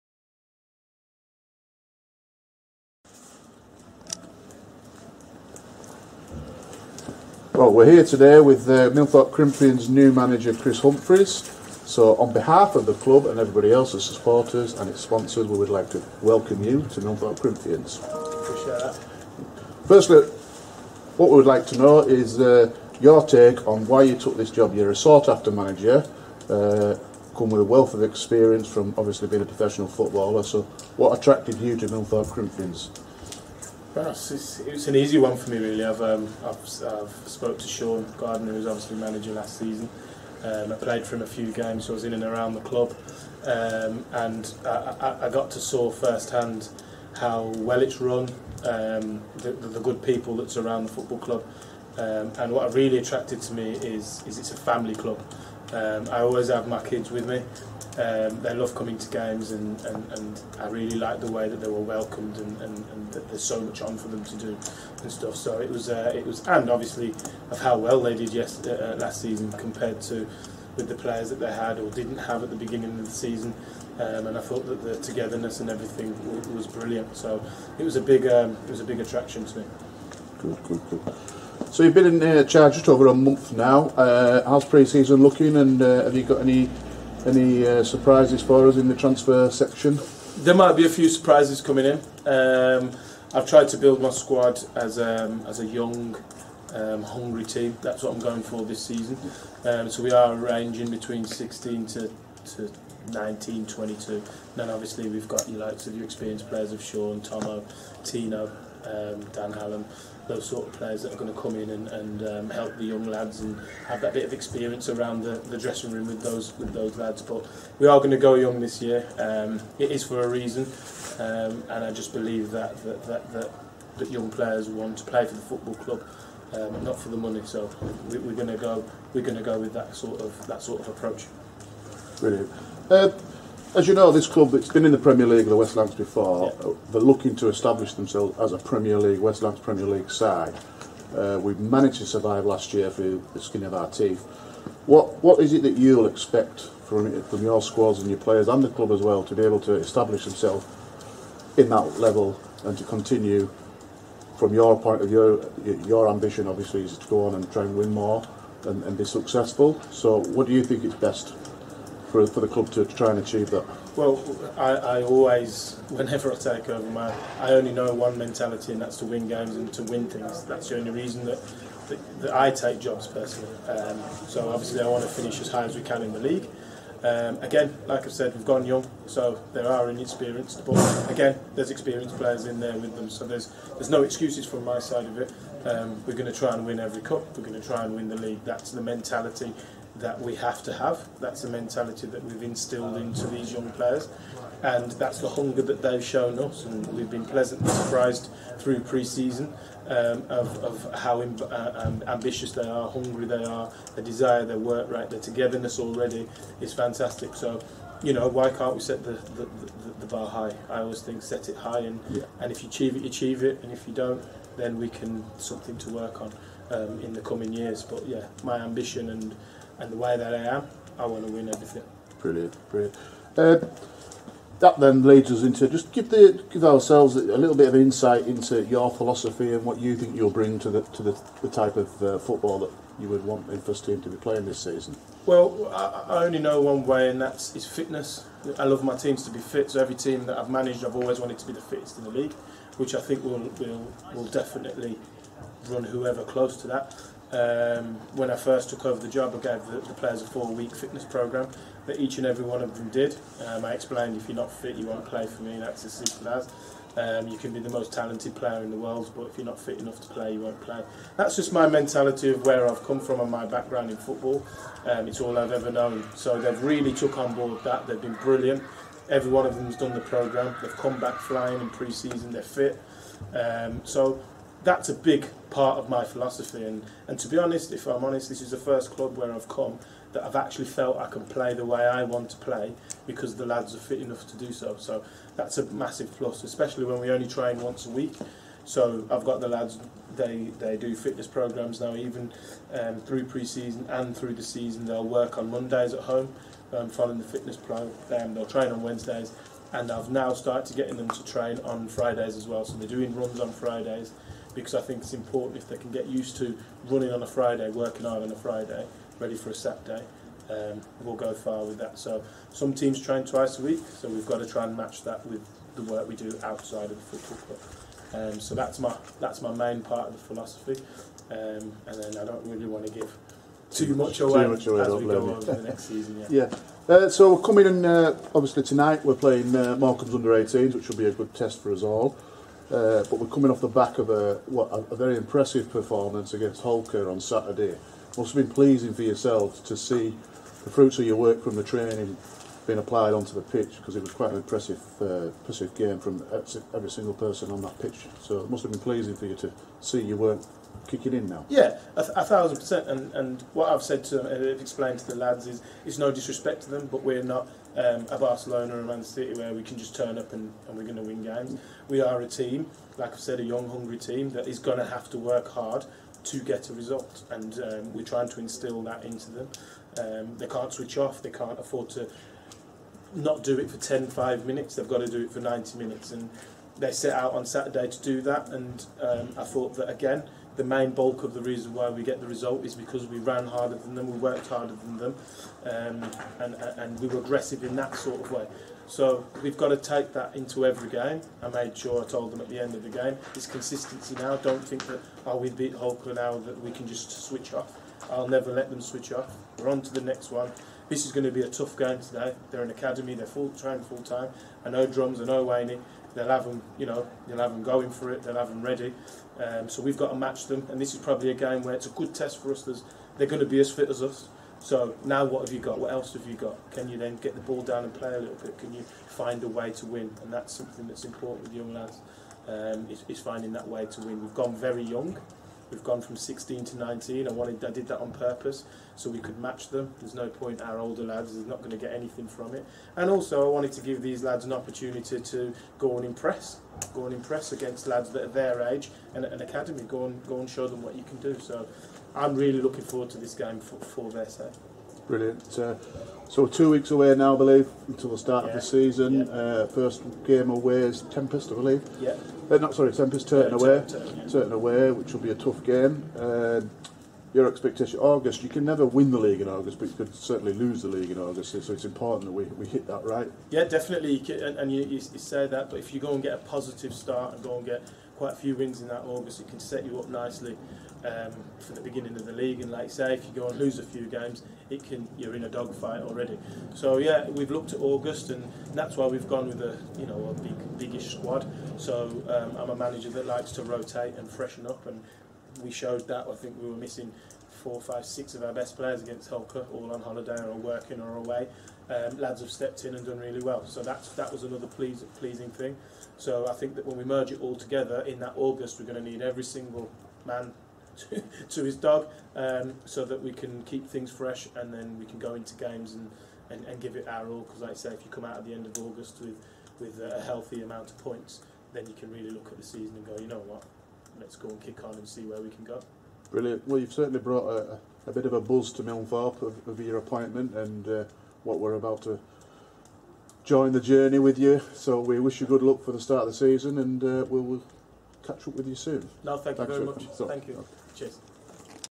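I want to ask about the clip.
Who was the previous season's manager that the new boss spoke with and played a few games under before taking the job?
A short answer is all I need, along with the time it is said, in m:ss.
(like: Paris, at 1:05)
Sean Gardner, at 0:37.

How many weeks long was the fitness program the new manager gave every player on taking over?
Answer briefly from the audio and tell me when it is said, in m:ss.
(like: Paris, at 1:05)
four-week, at 4:10.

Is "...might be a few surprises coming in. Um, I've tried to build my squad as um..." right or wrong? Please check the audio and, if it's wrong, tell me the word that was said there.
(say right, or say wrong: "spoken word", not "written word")
right.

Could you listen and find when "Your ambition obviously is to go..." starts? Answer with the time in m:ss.
2:35.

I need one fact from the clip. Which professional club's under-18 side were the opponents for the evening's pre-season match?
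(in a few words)
Morecambe.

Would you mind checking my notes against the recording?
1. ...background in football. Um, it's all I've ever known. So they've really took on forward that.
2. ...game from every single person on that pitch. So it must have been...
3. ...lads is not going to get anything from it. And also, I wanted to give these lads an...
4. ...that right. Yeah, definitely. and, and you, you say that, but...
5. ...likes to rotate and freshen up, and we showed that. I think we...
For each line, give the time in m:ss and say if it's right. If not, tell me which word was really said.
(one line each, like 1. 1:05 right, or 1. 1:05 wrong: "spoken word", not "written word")
1. 4:23 wrong: "board", not "forward"
2. 5:45 right
3. 7:11 right
4. 7:42 right
5. 8:03 right.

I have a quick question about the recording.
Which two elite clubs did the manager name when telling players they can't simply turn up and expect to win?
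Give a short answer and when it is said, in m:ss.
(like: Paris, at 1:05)
Barcelona and Man City, at 5:58.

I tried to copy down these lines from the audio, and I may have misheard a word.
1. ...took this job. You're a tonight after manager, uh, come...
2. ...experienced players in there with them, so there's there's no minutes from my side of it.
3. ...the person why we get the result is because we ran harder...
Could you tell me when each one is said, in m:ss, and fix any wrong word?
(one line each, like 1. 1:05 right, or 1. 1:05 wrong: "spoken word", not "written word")
1. 0:24 wrong: "sought", not "tonight"
2. 3:01 wrong: "excuses", not "minutes"
3. 6:21 wrong: "reason", not "person".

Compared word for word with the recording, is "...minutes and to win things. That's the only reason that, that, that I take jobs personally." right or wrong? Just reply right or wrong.
wrong.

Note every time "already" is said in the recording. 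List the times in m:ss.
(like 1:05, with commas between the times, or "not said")
3:25, 7:56.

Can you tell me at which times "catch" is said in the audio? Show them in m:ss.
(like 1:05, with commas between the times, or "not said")
8:48.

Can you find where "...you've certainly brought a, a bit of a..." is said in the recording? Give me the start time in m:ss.
8:36.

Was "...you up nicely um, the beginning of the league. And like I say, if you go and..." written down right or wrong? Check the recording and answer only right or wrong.
right.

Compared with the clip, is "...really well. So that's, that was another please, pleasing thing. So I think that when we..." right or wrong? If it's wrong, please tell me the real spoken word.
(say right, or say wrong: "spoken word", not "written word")
right.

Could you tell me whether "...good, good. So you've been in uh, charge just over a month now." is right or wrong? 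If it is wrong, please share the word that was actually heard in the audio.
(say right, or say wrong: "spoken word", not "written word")
right.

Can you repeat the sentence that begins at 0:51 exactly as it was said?
Um, and what really attracted to me is, is it's a family club.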